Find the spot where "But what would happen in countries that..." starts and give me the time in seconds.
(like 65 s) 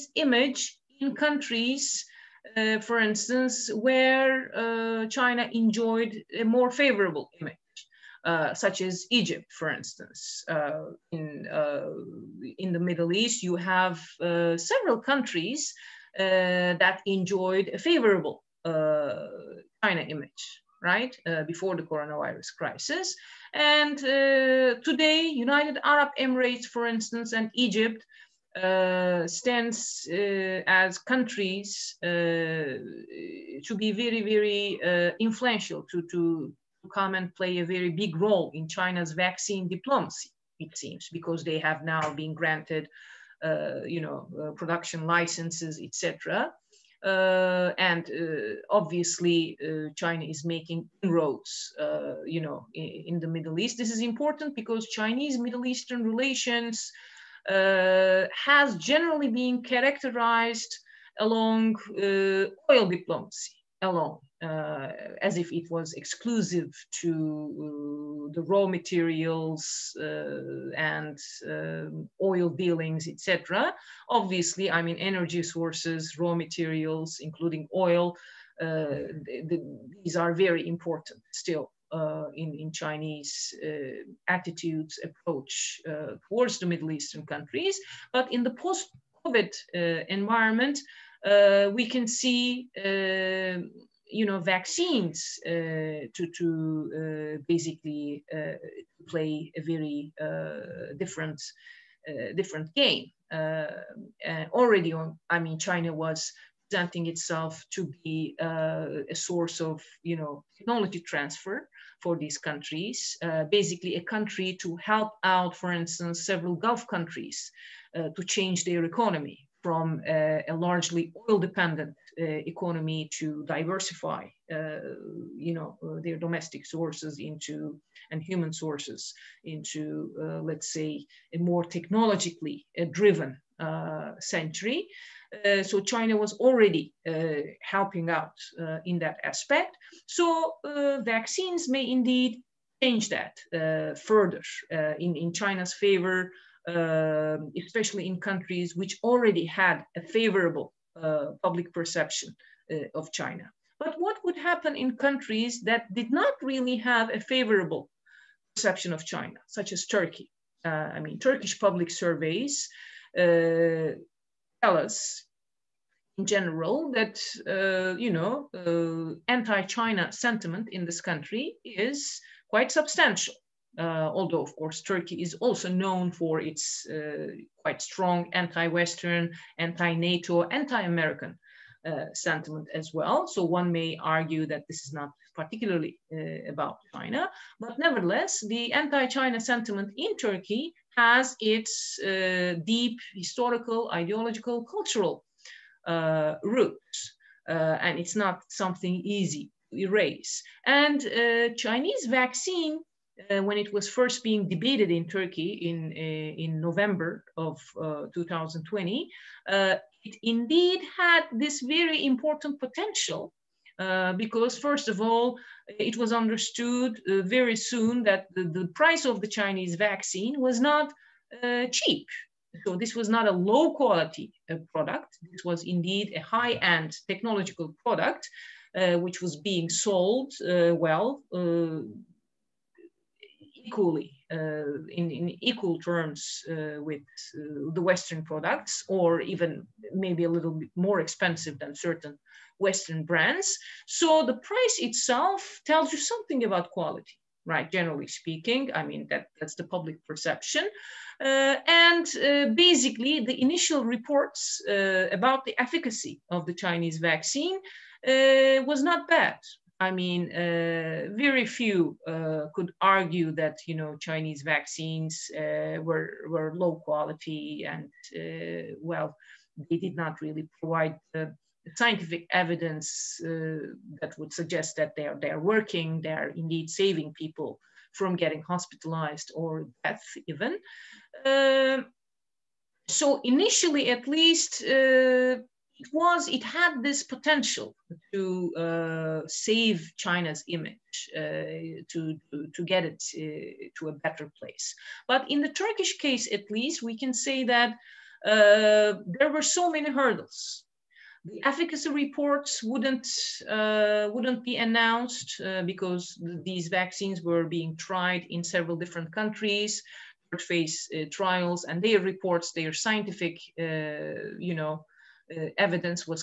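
153 s.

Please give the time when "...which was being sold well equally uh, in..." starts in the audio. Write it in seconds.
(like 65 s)
228 s.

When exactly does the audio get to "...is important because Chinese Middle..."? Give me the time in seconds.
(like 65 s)
53 s.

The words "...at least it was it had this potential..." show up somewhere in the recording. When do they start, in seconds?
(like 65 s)
283 s.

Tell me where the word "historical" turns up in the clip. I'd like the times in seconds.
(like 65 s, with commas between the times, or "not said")
193 s.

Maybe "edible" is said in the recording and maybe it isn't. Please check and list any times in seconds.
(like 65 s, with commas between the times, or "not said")
not said.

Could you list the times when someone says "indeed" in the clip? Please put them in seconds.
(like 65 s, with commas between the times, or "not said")
141 s, 210 s, 225 s, 276 s.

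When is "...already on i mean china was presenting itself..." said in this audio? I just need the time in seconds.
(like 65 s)
104 s.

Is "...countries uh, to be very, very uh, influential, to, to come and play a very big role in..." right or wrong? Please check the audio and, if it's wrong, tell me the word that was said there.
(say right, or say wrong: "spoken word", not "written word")
right.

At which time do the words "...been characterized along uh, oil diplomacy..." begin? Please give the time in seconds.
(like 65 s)
59 s.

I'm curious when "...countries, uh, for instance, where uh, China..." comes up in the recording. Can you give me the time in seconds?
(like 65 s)
1 s.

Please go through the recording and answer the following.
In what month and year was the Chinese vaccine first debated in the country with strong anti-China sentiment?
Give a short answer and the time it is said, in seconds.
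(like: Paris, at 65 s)
November 2020, at 206 s.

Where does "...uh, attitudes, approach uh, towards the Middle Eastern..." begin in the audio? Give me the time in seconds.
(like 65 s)
83 s.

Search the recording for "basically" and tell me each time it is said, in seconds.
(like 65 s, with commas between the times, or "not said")
97 s, 113 s, 252 s.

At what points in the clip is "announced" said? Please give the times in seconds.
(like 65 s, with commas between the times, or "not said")
304 s.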